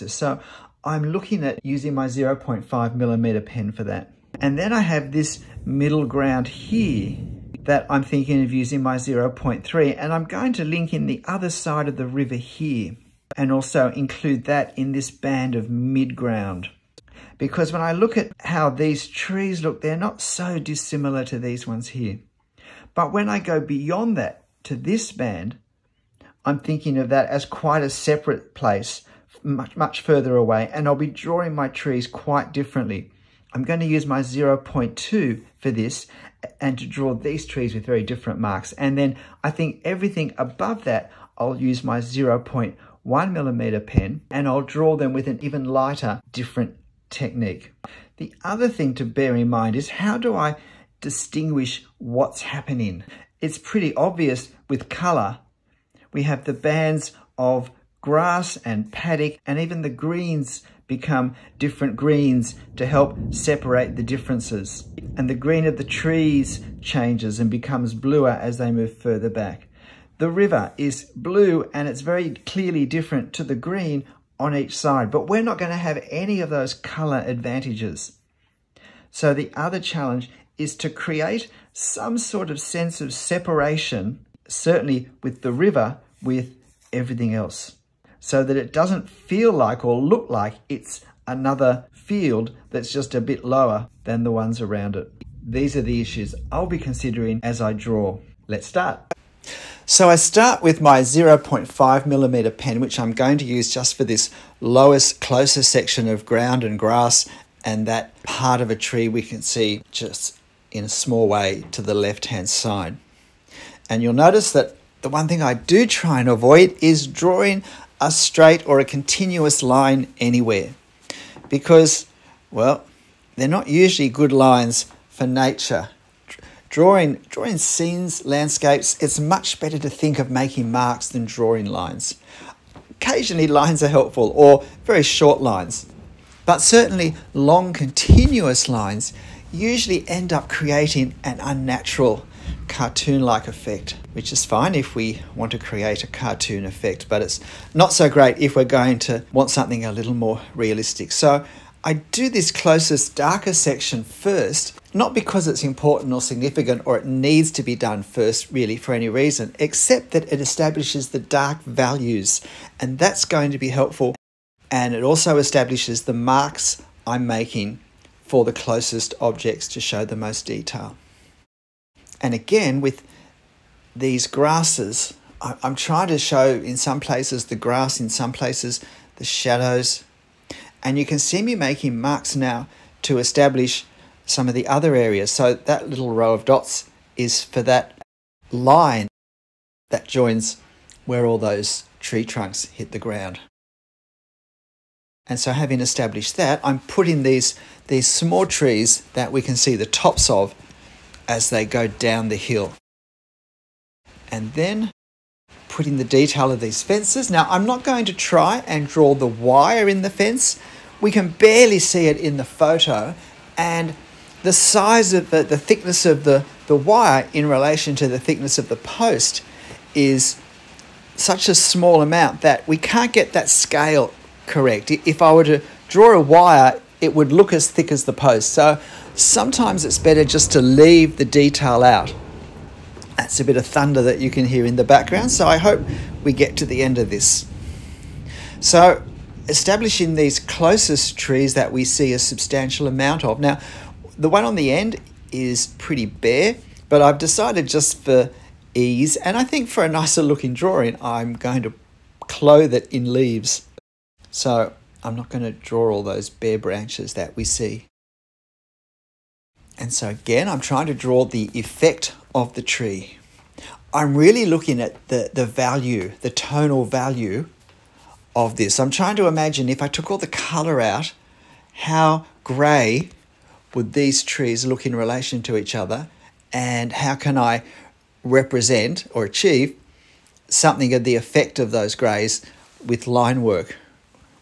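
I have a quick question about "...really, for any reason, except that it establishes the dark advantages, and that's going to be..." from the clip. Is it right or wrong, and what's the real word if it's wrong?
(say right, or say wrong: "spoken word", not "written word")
wrong: "values", not "advantages".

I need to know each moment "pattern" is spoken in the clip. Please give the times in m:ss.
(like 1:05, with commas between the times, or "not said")
not said.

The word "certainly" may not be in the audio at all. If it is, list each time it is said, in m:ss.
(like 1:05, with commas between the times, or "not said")
1:24, 2:16.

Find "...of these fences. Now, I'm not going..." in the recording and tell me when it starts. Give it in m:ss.
3:26.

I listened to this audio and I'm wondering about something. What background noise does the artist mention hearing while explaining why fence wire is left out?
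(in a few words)
Thunder.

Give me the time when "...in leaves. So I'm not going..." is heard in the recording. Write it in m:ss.
4:12.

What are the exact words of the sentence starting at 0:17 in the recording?
Because when I look at how these trees look, they're not so dissimilar to these ones here.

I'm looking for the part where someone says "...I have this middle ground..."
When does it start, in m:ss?
0:04.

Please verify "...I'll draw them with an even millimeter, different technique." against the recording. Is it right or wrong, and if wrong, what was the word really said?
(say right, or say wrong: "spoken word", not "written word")
wrong: "lighter", not "millimeter".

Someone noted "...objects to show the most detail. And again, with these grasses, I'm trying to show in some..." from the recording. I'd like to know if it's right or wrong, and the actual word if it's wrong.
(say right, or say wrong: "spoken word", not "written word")
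right.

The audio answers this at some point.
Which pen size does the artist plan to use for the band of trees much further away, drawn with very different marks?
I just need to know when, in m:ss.
0:34.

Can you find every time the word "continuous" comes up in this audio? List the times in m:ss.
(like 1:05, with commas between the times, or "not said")
1:58, 2:17.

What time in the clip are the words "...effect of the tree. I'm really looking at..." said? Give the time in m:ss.
4:21.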